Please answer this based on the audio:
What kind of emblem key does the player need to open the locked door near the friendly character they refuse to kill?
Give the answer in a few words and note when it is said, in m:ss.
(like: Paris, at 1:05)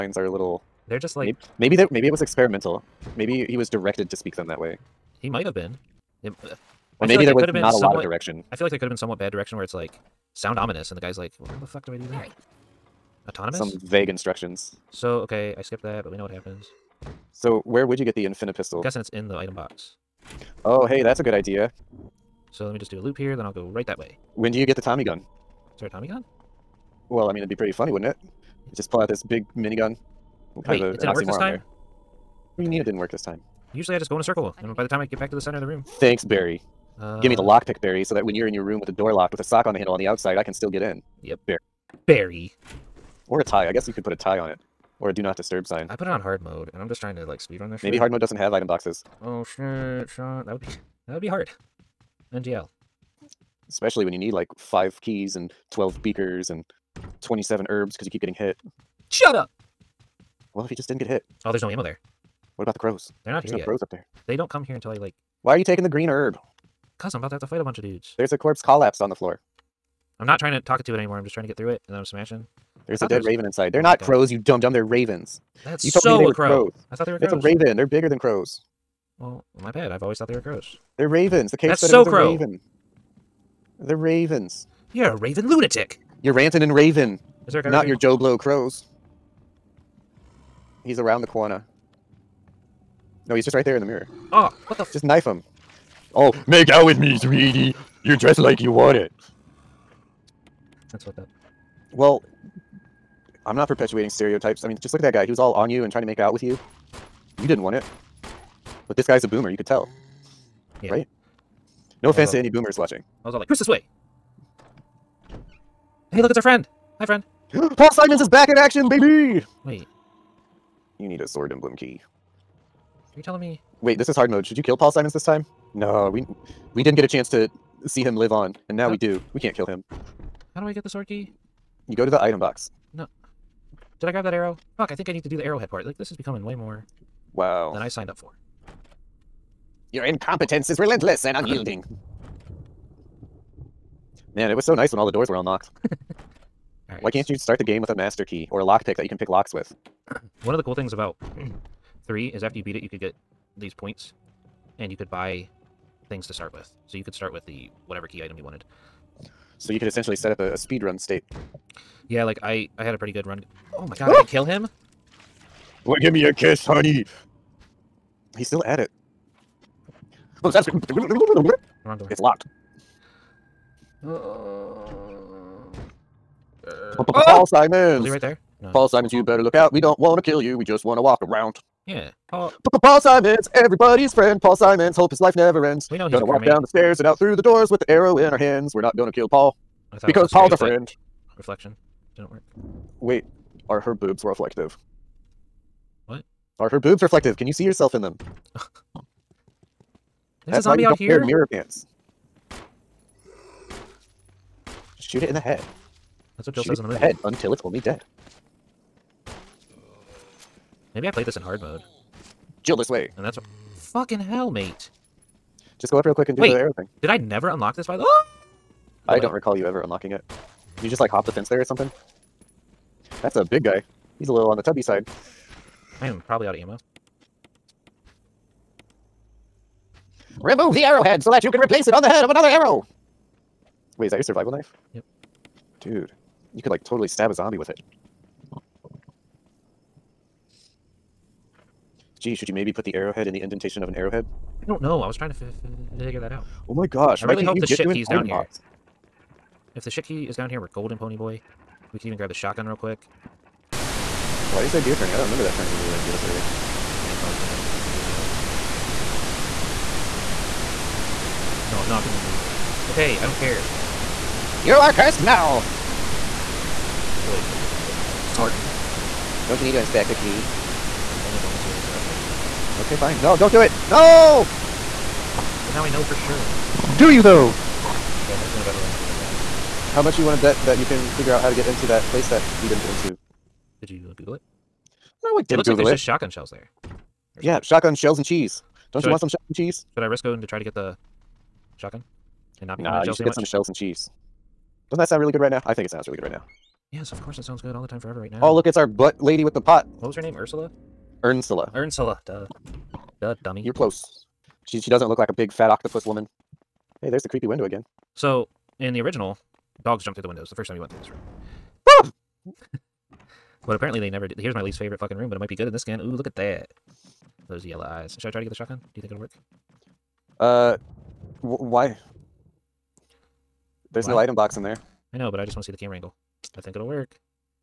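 Sword emblem key, at 2:01.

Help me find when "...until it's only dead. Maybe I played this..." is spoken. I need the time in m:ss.
3:27.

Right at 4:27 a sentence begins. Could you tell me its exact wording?
I fully expected a zombie to jump out because it's hard mode.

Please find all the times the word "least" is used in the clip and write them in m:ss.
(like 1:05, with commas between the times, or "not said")
5:14.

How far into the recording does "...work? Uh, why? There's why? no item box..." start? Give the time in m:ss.
5:19.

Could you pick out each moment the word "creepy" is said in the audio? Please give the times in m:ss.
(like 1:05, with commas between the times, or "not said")
4:17, 5:07.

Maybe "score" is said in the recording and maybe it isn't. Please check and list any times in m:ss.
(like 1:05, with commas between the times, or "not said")
not said.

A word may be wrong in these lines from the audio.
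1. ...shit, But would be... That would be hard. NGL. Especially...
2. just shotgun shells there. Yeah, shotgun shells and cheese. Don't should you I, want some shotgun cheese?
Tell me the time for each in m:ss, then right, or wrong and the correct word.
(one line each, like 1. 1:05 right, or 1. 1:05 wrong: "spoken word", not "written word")
1. 0:49 wrong: "That", not "But"
2. 4:45 right.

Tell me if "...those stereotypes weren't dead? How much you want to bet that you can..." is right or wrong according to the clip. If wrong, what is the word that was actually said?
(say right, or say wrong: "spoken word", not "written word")
wrong: "zombies", not "stereotypes".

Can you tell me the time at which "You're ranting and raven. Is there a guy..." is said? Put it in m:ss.
1:26.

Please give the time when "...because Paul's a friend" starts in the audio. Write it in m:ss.
3:10.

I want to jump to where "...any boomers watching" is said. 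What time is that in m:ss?
1:52.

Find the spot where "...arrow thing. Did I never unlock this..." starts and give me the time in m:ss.
3:36.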